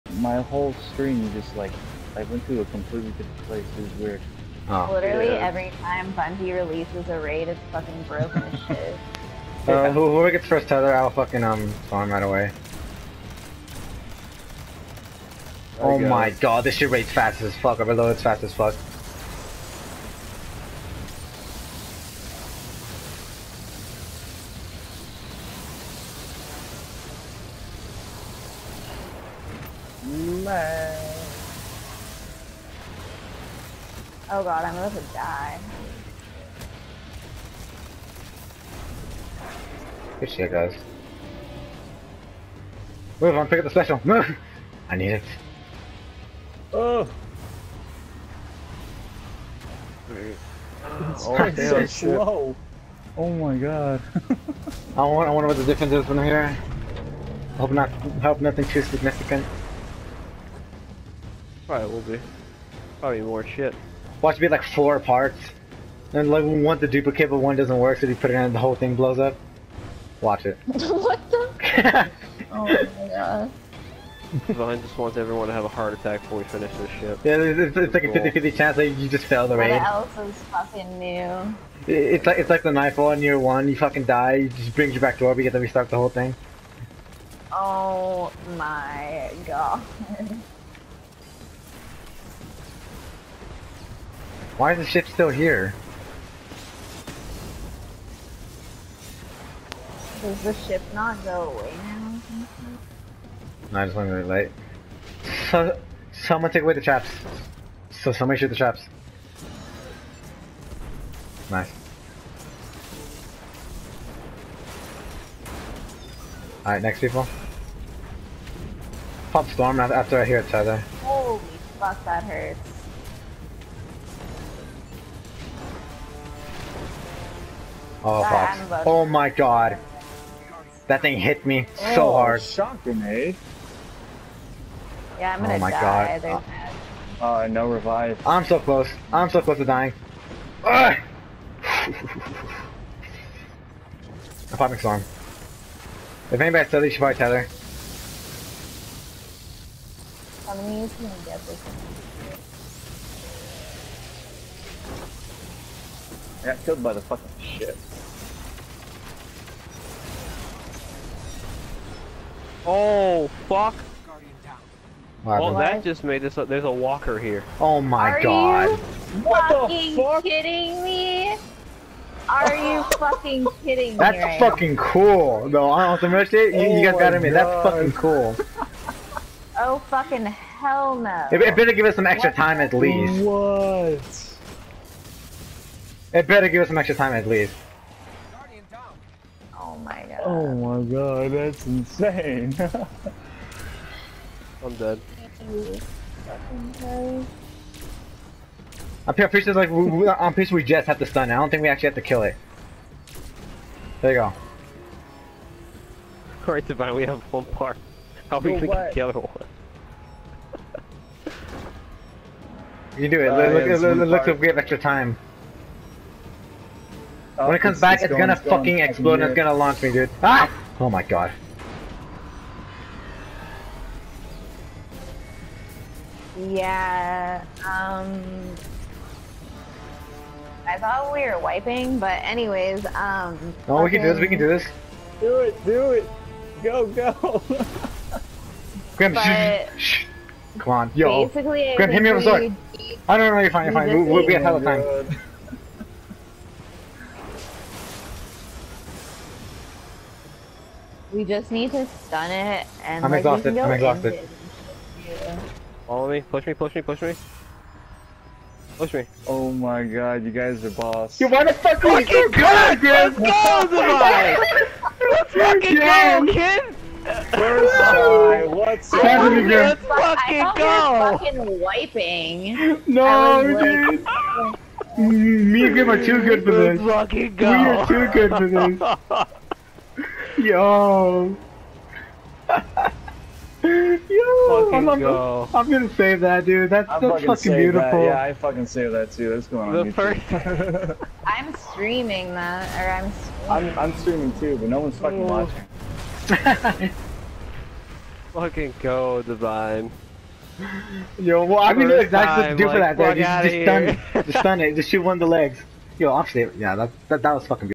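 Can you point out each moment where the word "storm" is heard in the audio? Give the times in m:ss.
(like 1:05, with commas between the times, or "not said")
1:59, 2:24.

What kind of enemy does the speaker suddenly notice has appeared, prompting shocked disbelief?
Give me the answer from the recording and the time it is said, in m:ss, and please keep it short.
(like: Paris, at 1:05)
a walker, at 2:46.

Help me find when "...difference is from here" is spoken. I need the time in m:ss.
0:55.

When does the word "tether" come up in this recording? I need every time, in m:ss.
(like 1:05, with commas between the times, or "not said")
0:10, 2:00, 2:27.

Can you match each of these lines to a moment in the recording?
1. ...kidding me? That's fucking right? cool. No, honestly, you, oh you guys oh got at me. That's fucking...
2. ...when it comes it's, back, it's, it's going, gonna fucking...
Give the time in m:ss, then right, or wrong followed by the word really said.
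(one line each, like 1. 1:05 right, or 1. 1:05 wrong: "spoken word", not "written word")
1. 2:53 right
2. 3:37 right.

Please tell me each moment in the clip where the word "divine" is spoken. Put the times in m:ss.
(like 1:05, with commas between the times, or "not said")
3:26, 4:59.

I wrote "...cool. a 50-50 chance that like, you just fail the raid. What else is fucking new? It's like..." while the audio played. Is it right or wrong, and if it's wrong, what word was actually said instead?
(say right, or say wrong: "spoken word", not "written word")
right.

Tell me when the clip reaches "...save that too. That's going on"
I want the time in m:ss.
4:48.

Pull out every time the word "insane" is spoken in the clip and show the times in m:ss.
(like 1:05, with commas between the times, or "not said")
3:11.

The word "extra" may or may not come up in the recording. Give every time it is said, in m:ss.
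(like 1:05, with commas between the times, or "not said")
3:02, 3:06, 3:34.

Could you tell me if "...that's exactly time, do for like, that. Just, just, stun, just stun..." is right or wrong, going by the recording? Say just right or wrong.
right.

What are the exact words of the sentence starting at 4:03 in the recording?
We'll, we'll be a hell of time.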